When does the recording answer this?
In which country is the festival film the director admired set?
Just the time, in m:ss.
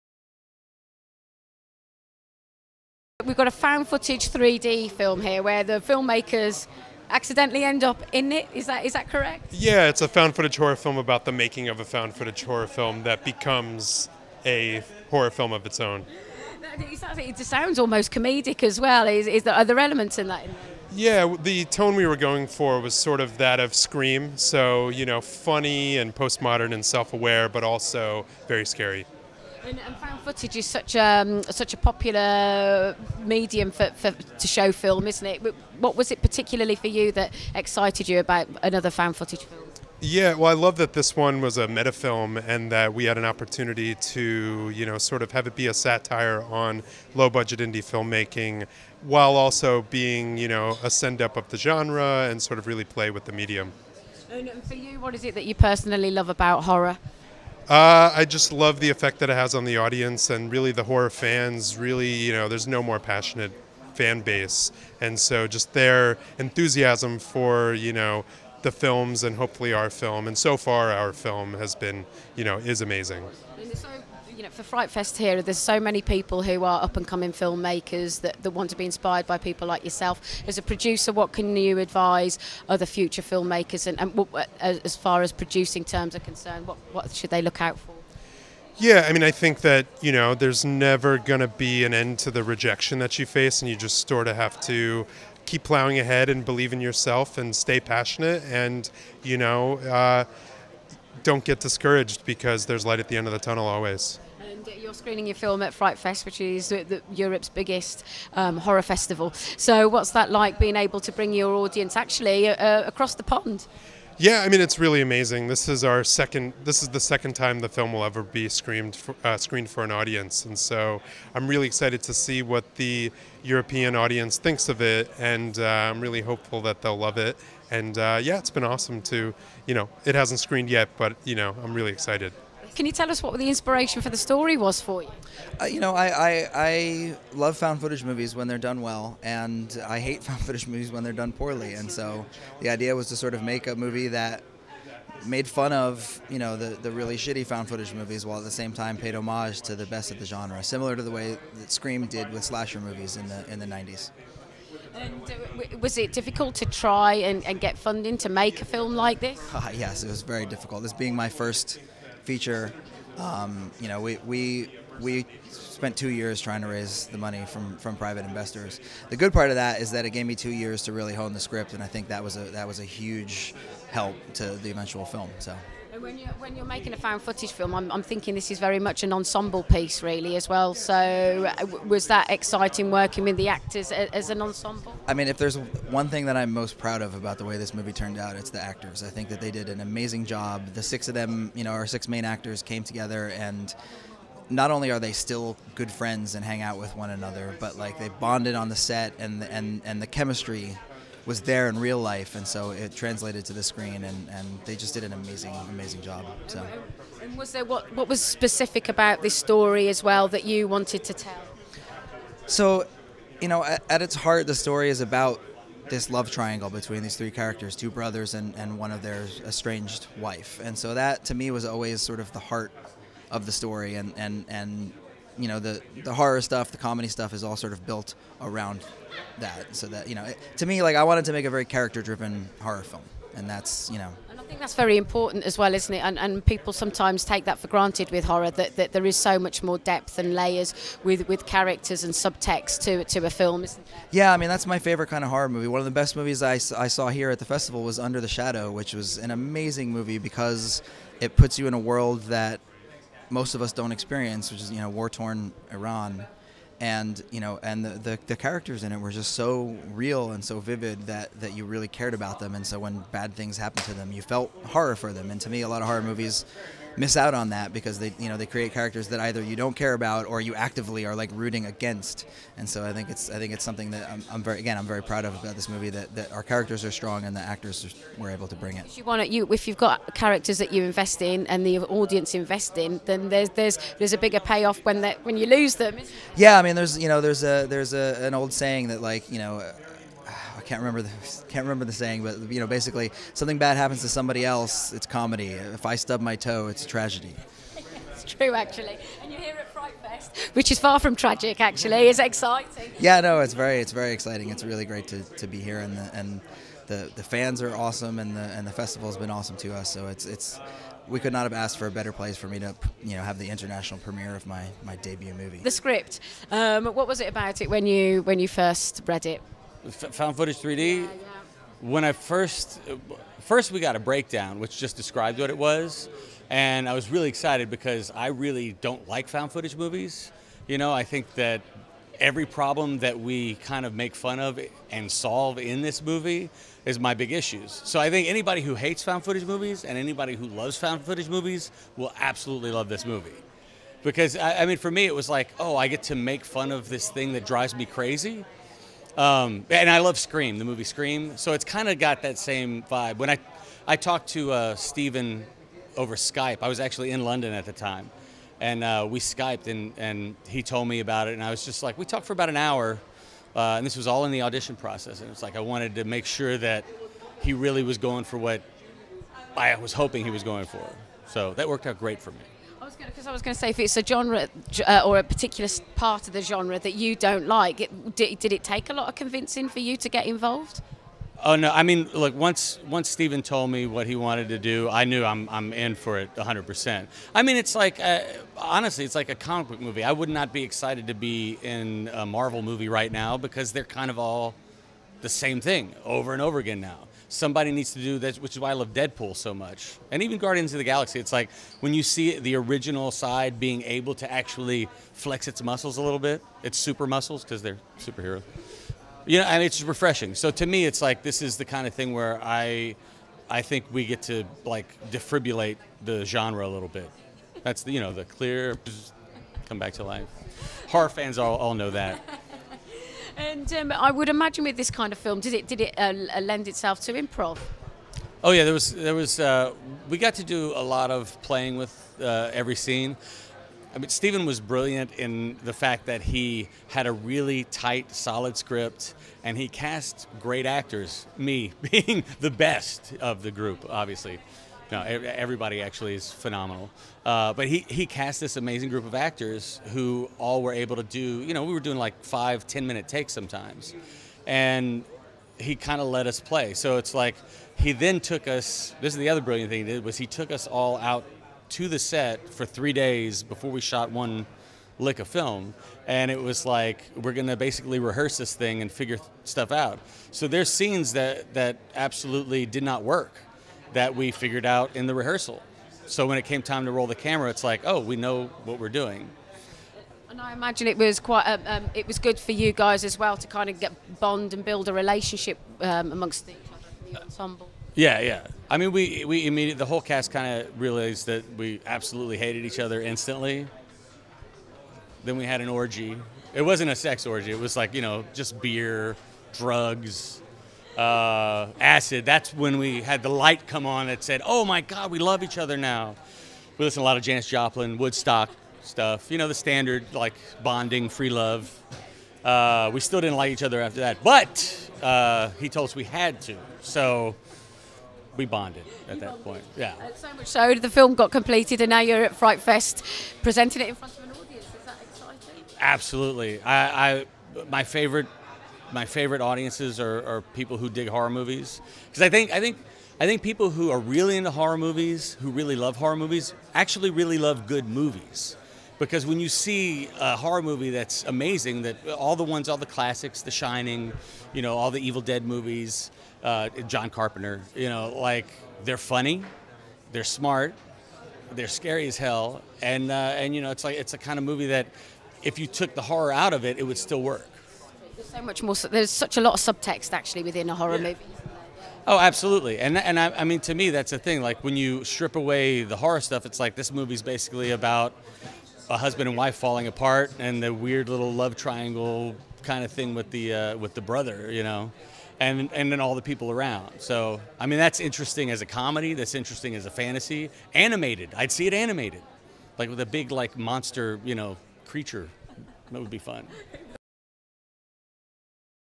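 4:15.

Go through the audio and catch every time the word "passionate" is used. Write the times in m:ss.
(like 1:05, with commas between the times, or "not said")
1:02, 1:37.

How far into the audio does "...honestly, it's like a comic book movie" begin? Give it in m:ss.
6:28.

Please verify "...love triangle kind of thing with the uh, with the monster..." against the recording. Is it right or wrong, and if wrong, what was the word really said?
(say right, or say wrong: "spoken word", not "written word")
wrong: "brother", not "monster".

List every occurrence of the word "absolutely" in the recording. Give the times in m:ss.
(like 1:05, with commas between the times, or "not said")
5:42, 7:51, 8:11, 8:45, 9:22.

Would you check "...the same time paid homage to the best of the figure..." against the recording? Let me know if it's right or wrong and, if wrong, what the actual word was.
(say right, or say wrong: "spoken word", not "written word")
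wrong: "genre", not "figure".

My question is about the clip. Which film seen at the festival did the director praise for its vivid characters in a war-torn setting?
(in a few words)
Under the Shadow.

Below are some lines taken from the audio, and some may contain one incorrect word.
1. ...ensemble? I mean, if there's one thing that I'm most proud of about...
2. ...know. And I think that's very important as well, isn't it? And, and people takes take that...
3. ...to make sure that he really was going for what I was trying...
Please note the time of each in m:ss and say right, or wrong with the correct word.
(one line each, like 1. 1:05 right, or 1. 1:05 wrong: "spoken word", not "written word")
1. 3:04 right
2. 3:53 wrong: "sometimes", not "takes"
3. 6:05 wrong: "hoping", not "trying".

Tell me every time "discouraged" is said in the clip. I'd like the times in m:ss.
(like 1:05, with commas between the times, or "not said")
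1:41.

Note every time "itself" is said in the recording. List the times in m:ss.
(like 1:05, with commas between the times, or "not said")
7:06.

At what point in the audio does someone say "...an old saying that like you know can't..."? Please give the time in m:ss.
4:48.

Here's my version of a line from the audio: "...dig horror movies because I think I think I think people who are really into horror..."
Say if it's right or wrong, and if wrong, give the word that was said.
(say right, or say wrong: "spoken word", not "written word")
right.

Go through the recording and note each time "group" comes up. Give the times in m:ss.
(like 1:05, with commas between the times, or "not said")
7:23, 7:28.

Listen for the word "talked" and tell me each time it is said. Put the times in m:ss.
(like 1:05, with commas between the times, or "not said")
5:53, 6:02.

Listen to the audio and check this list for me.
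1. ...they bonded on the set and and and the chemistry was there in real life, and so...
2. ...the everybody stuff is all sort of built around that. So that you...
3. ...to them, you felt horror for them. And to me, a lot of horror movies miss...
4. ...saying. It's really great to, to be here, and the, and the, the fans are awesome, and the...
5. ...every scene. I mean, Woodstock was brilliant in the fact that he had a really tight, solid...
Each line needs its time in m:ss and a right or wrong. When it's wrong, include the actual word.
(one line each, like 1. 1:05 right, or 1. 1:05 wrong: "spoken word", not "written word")
1. 3:17 right
2. 3:46 wrong: "comedy", not "everybody"
3. 4:23 right
4. 5:04 wrong: "exciting", not "saying"
5. 7:12 wrong: "Steven", not "Woodstock".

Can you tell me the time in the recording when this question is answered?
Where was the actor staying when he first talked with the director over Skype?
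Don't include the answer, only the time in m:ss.
5:57.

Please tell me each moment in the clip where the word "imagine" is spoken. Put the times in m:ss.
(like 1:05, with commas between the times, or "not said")
7:04, 8:00.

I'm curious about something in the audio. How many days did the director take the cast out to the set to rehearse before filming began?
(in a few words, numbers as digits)
3 days.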